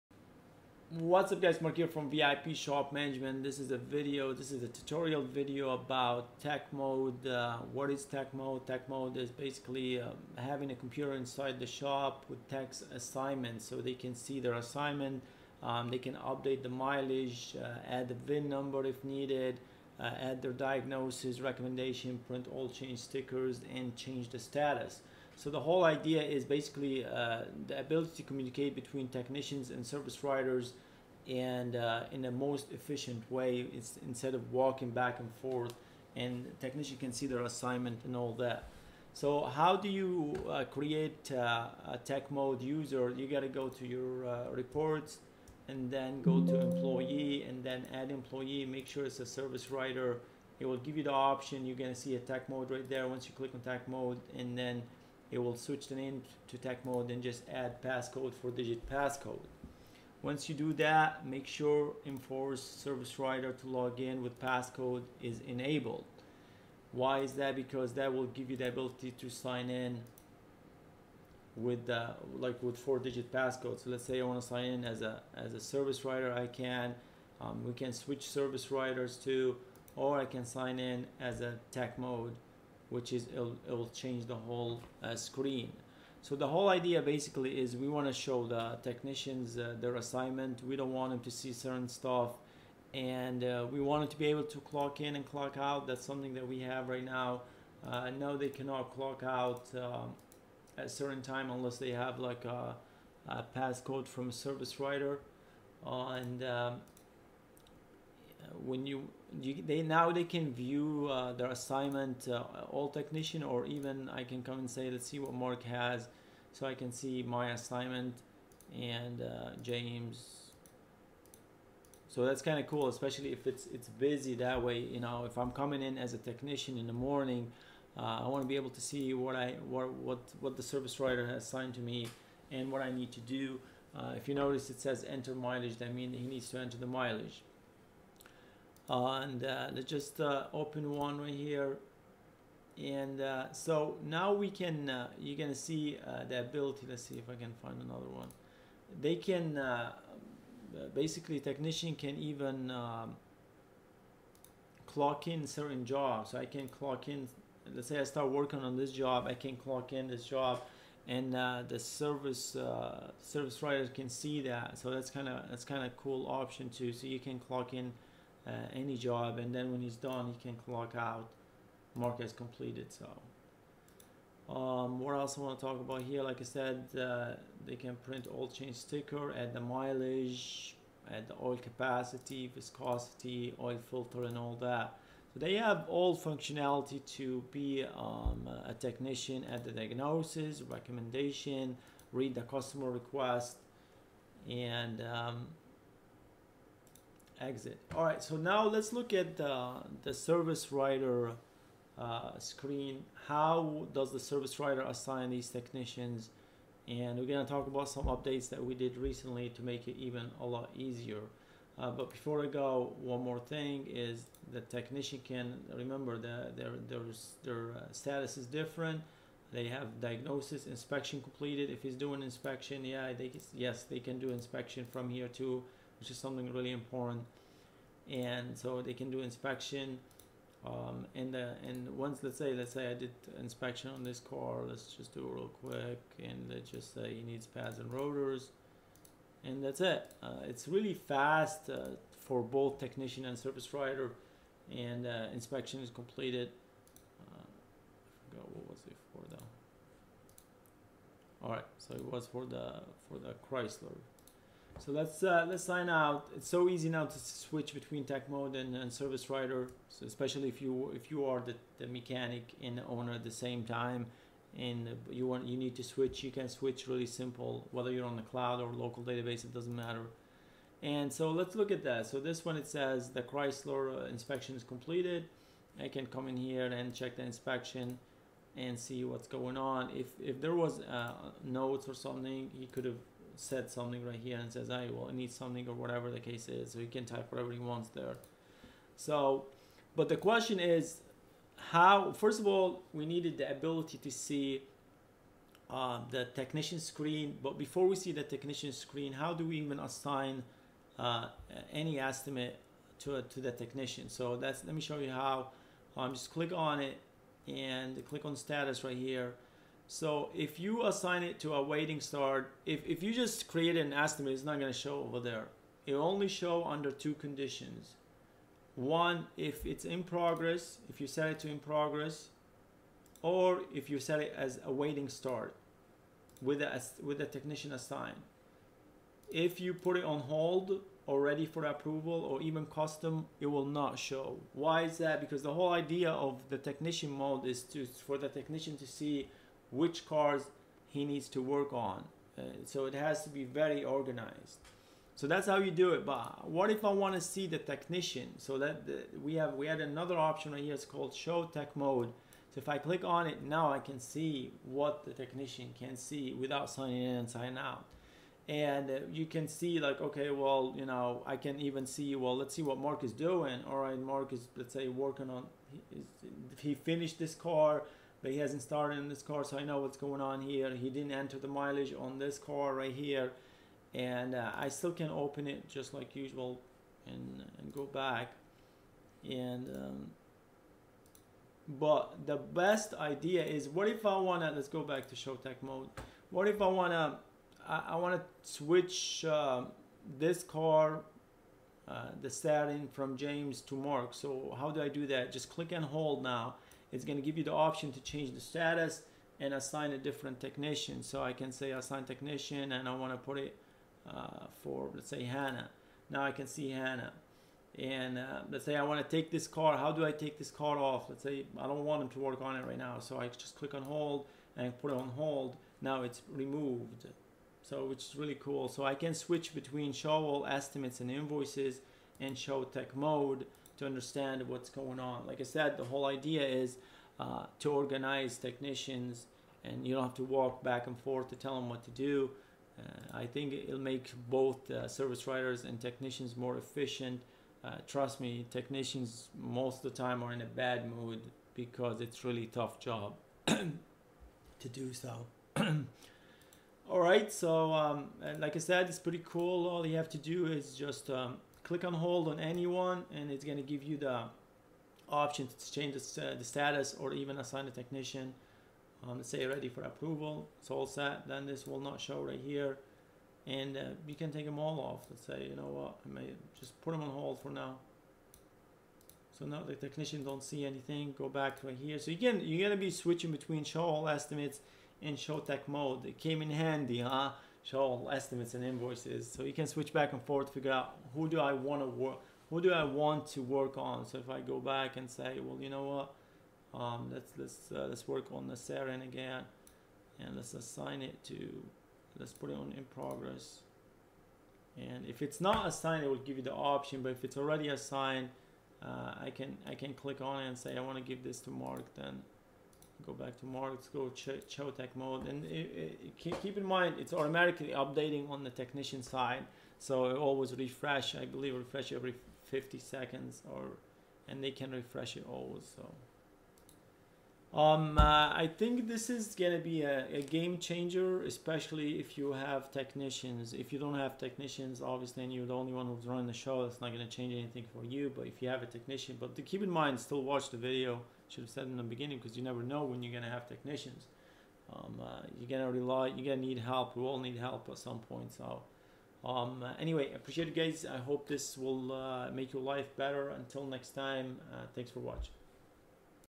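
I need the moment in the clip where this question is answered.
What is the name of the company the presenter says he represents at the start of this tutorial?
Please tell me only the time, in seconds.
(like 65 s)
2 s.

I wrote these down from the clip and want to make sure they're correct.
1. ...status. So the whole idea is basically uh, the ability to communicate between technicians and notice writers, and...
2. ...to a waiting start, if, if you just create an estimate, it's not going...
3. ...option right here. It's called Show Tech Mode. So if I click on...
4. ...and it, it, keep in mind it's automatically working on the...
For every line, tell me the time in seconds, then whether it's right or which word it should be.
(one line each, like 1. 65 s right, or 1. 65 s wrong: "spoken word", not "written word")
1. 24 s wrong: "service", not "notice"
2. 311 s right
3. 350 s right
4. 505 s wrong: "updating", not "working".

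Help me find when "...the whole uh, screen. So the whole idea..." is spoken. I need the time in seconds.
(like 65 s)
84 s.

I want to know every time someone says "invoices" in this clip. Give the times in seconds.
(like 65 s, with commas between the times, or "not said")
421 s, 478 s.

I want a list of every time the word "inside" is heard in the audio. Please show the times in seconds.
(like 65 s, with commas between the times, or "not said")
11 s.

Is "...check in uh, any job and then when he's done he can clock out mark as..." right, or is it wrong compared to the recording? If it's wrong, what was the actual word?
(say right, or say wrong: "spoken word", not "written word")
wrong: "clock", not "check".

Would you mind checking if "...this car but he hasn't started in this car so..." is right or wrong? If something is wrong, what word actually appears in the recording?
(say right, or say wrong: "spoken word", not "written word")
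right.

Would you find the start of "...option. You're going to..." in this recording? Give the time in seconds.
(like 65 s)
51 s.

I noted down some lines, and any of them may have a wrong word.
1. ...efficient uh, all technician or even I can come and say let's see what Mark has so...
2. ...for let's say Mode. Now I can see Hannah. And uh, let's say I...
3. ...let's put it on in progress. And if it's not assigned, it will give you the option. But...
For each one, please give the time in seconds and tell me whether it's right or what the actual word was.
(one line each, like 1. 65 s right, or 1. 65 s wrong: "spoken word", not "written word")
1. 111 s wrong: "assignment", not "efficient"
2. 404 s wrong: "Hannah", not "Mode"
3. 492 s right.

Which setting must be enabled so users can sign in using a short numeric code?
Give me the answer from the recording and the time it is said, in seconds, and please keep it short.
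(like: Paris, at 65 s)
enforce service writer to log in with passcode, at 62 s.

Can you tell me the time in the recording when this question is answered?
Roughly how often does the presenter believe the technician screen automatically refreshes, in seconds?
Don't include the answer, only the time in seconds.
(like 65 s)
512 s.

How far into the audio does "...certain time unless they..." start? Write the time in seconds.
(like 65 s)
100 s.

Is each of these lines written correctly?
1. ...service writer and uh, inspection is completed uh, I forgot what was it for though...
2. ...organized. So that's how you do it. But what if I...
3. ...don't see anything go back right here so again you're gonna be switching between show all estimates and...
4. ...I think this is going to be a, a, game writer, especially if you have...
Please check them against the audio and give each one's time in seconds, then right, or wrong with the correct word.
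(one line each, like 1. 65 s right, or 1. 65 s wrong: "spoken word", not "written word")
1. 243 s right
2. 343 s right
3. 470 s right
4. 518 s wrong: "changer", not "writer".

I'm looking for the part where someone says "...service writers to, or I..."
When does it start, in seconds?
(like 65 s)
78 s.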